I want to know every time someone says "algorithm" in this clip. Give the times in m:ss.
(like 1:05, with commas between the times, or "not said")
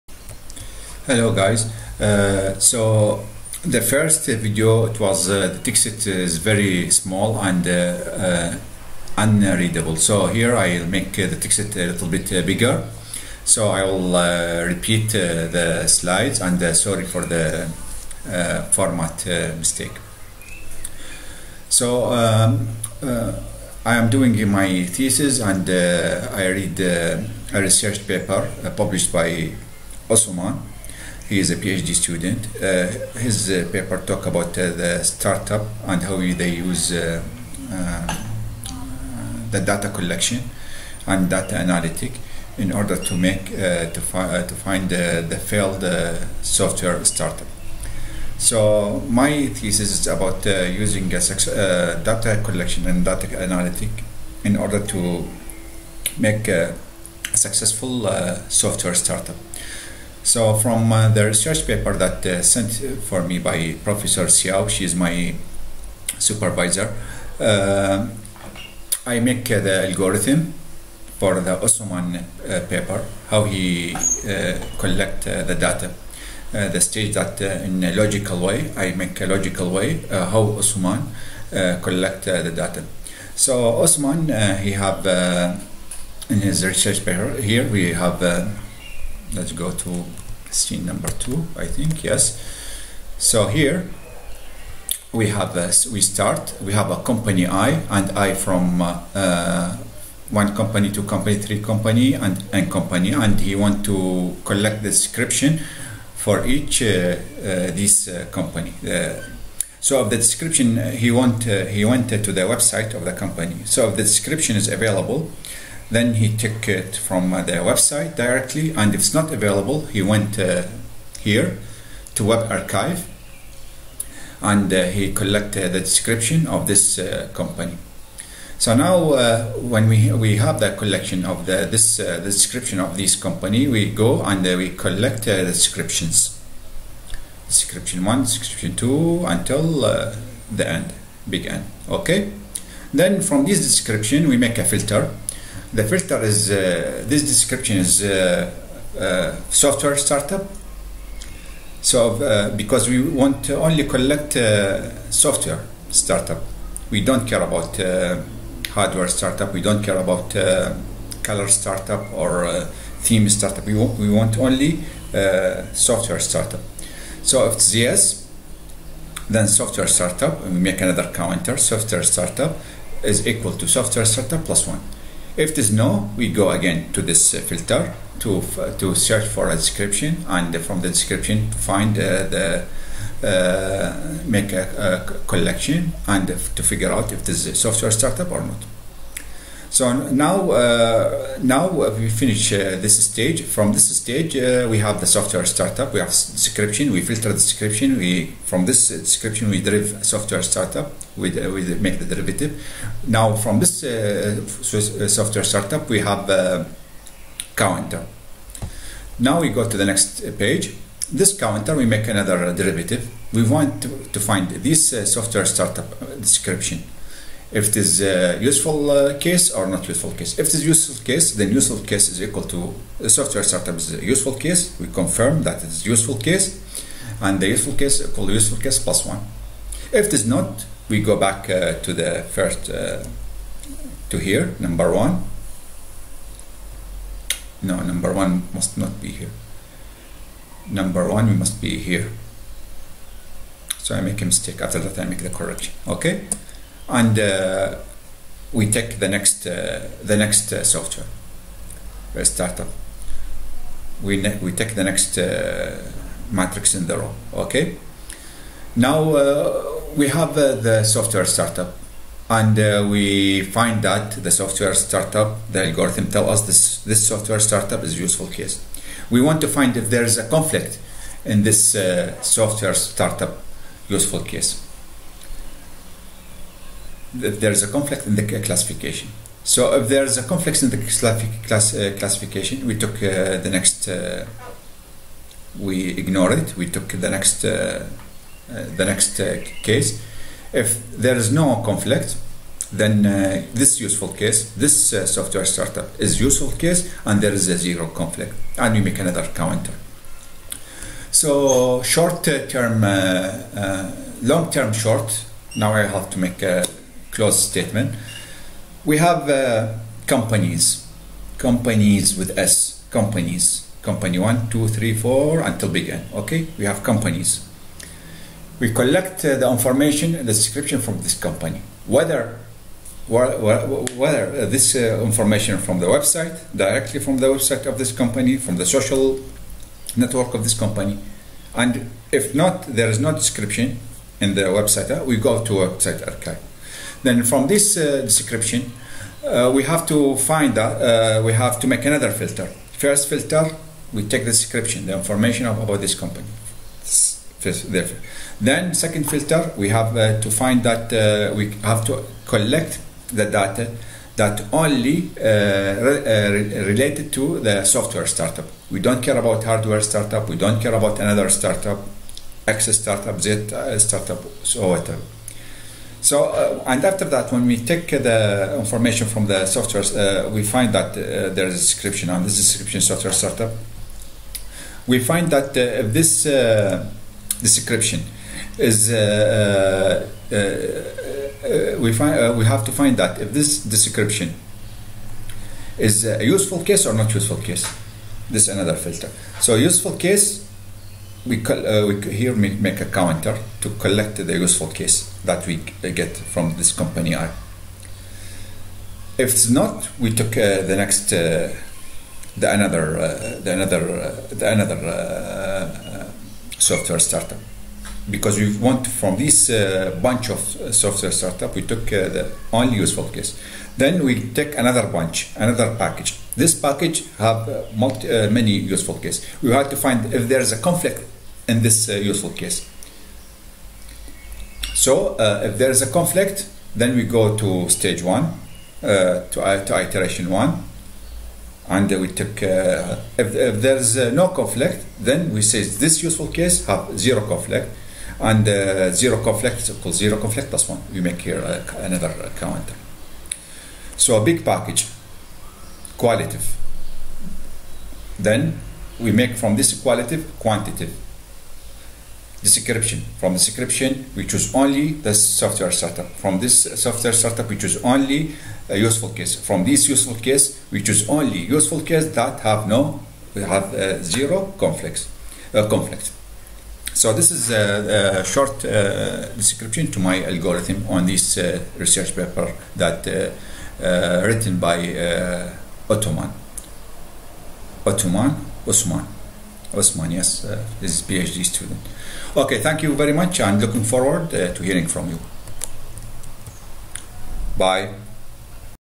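1:09, 4:25, 7:50.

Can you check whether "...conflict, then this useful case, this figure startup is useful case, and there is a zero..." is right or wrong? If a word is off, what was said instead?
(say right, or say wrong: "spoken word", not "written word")
wrong: "software", not "figure".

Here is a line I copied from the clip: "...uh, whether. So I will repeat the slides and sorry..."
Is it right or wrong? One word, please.
wrong.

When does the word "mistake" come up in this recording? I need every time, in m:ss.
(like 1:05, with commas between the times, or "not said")
0:19, 4:04.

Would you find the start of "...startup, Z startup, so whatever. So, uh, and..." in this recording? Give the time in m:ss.
6:02.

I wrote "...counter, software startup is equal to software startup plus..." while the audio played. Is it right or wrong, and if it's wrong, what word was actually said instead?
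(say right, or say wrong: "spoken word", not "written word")
right.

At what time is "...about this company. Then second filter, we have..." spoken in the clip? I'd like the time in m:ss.
5:45.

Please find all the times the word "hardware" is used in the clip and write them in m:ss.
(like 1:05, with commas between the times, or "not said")
2:38, 5:59.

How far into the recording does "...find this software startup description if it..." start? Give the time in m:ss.
3:34.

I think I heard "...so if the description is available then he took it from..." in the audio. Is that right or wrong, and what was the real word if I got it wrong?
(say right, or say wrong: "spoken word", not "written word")
right.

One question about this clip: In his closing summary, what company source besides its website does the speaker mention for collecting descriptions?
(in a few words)
social network.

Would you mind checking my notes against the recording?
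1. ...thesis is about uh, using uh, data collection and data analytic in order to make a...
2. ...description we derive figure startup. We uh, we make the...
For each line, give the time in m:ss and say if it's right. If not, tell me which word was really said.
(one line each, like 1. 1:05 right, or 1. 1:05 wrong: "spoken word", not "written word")
1. 0:49 right
2. 3:18 wrong: "software", not "figure".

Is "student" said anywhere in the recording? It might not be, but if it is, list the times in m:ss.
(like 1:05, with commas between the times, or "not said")
0:31, 8:01.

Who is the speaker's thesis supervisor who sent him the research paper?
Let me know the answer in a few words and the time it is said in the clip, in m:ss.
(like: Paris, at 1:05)
Professor Xiao, at 1:03.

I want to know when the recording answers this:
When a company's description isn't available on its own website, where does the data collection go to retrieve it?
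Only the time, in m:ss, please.
2:02.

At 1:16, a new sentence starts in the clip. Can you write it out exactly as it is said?
Uh, the stage that uh, in a logical way, I make a logical way uh, how Osman collect the data.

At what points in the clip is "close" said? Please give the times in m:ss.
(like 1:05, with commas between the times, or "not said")
5:07.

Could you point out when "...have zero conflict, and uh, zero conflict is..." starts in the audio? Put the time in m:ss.
7:16.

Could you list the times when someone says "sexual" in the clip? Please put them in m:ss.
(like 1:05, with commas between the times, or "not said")
not said.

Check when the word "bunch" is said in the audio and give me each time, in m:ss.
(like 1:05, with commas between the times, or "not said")
6:50, 6:54.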